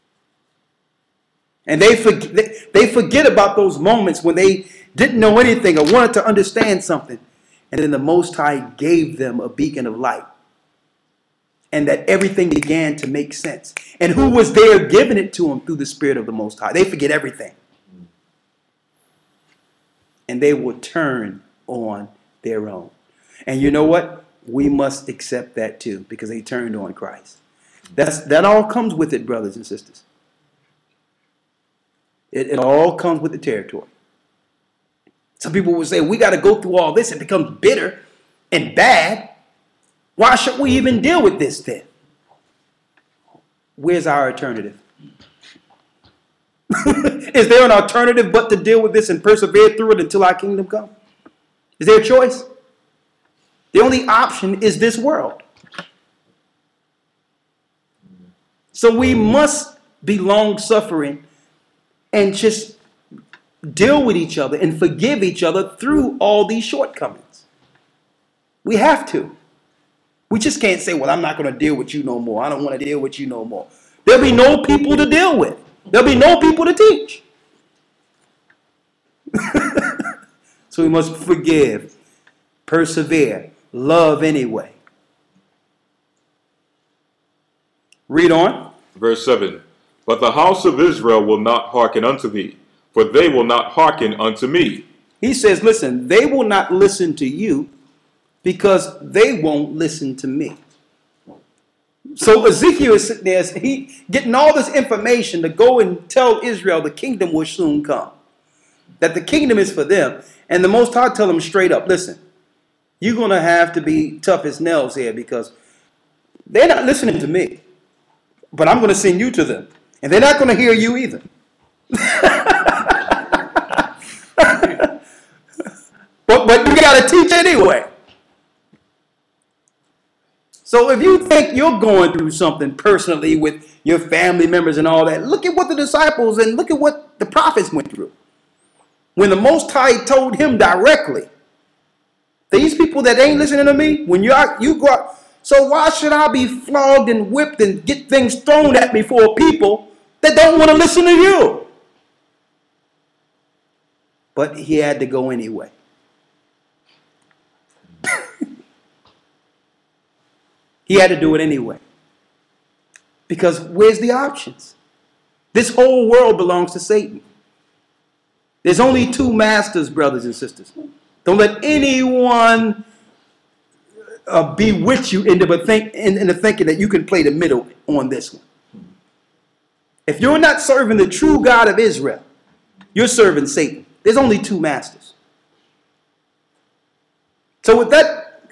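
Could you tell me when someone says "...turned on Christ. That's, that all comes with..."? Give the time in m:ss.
0:26.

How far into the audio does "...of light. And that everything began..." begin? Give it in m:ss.
0:09.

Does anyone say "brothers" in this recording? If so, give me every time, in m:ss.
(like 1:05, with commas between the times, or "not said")
0:29, 2:49.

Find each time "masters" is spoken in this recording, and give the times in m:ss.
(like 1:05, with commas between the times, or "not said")
2:49, 3:04.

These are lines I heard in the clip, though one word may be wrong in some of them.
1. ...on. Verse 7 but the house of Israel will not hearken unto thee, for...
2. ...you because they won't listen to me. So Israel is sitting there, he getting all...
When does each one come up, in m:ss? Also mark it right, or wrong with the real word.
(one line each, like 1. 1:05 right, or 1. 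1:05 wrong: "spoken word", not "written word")
1. 1:28 right
2. 1:37 wrong: "Ezekiel", not "Israel".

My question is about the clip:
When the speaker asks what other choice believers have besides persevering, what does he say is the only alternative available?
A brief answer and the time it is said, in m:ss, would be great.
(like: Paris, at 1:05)
This world, at 0:54.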